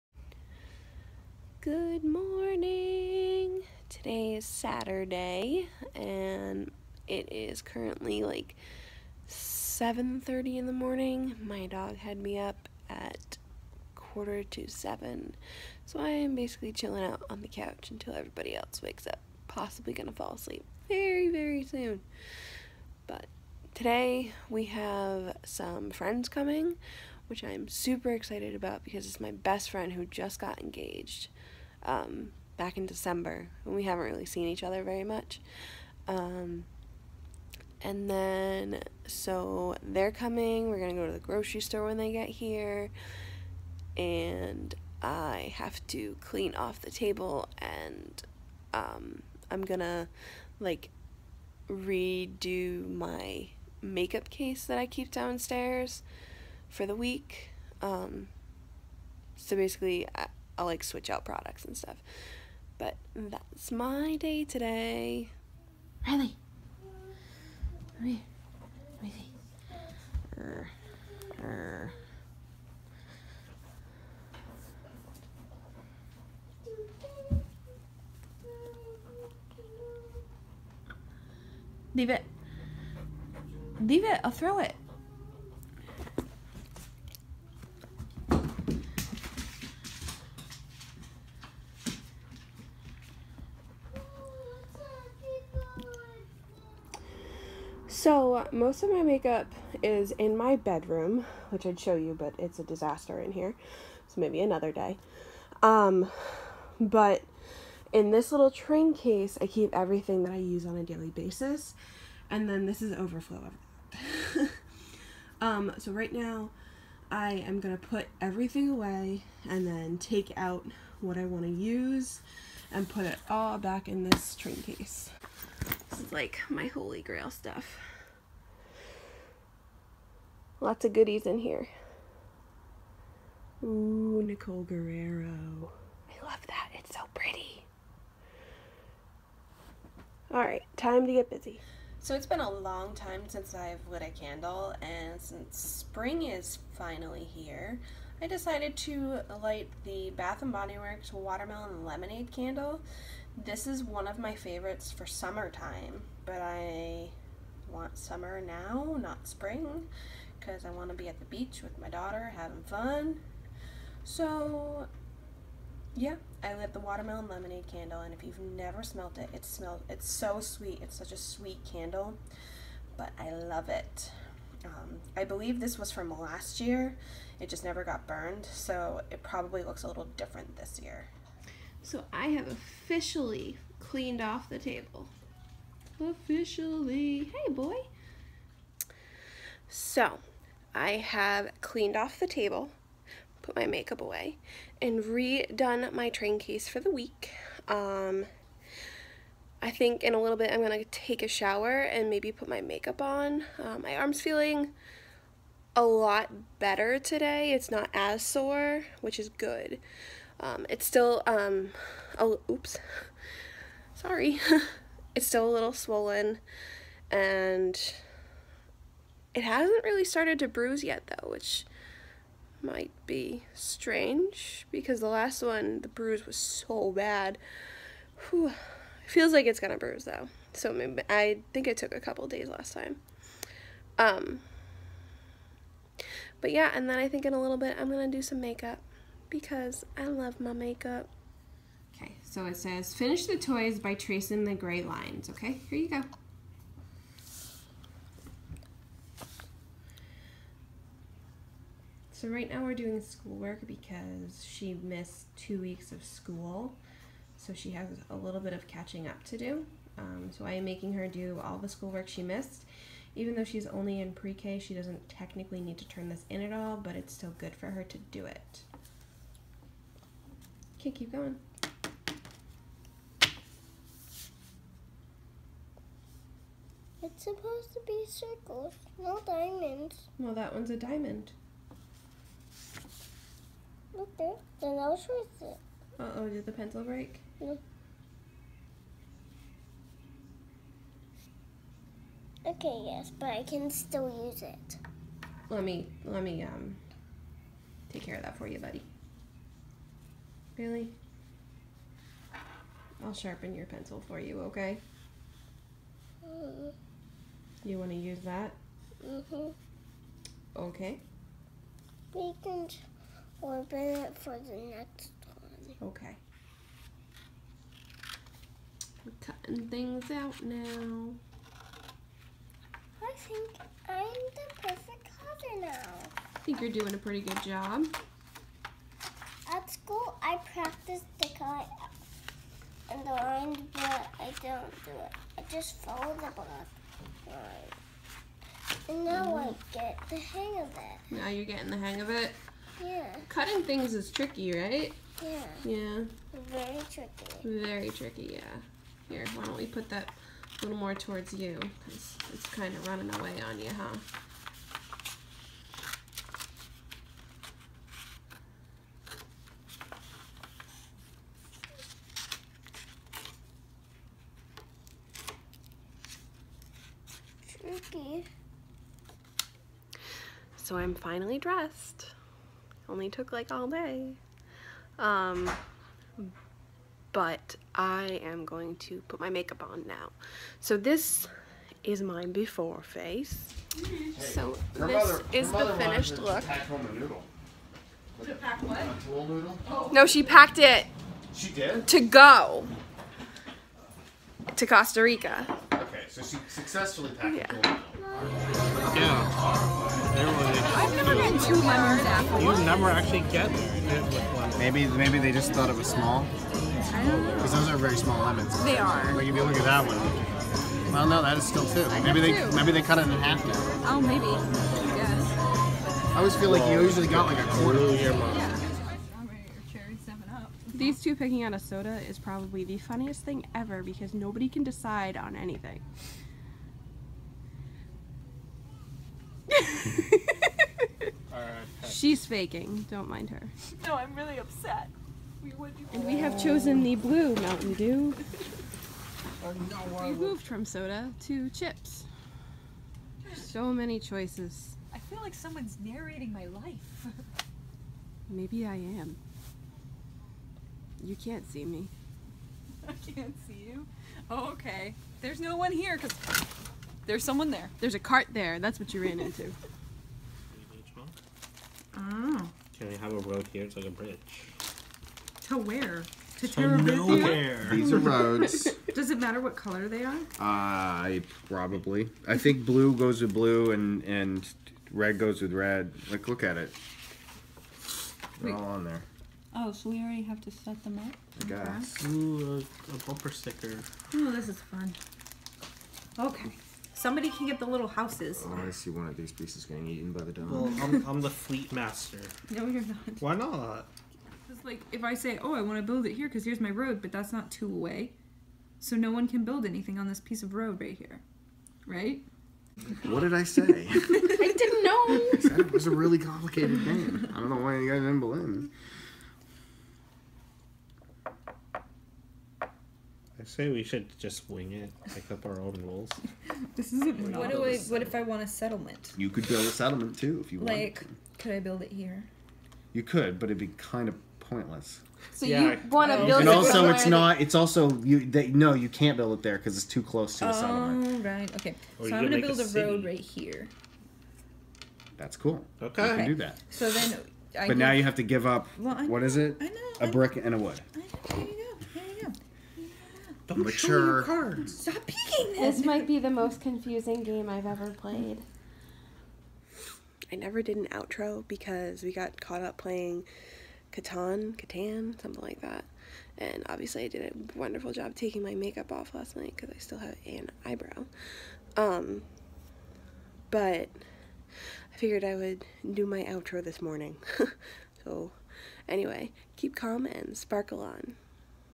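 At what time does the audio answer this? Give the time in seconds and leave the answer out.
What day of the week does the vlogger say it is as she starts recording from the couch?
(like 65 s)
4 s.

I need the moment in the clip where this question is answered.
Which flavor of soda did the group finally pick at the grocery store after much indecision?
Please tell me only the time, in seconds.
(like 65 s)
436 s.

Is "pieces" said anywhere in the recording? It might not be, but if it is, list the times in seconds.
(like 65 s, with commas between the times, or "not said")
489 s, 500 s.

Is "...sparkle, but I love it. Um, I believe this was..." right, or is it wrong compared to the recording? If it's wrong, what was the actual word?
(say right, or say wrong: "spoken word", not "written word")
wrong: "candle", not "sparkle".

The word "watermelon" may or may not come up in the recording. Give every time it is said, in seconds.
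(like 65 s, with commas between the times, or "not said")
151 s, 166 s.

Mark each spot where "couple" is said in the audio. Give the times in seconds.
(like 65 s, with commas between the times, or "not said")
231 s.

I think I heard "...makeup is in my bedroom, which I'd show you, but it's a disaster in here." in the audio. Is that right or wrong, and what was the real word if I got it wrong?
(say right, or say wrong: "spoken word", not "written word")
right.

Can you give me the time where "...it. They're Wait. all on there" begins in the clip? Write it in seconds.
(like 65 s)
476 s.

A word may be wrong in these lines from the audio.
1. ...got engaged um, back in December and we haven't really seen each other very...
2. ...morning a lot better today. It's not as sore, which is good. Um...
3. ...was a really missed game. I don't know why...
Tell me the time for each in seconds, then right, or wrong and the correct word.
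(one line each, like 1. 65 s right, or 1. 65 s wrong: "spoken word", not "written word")
1. 30 s right
2. 204 s wrong: "feeling", not "morning"
3. 505 s wrong: "complicated", not "missed".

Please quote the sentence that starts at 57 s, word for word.
Um, so basically, I'll like switch out products and stuff.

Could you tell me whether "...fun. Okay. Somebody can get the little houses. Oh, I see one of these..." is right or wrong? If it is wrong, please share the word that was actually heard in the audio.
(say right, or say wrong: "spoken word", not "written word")
right.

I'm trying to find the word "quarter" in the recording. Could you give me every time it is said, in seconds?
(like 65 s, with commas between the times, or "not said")
13 s, 417 s.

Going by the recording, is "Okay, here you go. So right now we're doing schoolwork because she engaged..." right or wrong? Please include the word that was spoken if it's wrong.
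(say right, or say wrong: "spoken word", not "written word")
wrong: "missed", not "engaged".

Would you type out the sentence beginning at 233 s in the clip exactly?
Um, but yeah, and then I think in a little bit I'm gonna do some makeup because I love my makeup.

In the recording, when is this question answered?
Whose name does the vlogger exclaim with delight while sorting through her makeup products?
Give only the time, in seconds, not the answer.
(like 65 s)
134 s.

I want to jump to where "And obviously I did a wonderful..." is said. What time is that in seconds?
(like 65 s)
556 s.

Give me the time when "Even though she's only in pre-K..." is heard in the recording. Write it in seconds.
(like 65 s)
263 s.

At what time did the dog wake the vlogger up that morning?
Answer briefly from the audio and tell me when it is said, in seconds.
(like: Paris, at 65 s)
6:45, at 13 s.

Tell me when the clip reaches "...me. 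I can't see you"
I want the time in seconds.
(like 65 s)
451 s.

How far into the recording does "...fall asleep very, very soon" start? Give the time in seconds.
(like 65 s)
20 s.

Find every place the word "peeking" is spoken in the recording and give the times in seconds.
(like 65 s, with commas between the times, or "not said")
545 s.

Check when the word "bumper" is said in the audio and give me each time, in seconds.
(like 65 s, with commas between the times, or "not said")
483 s.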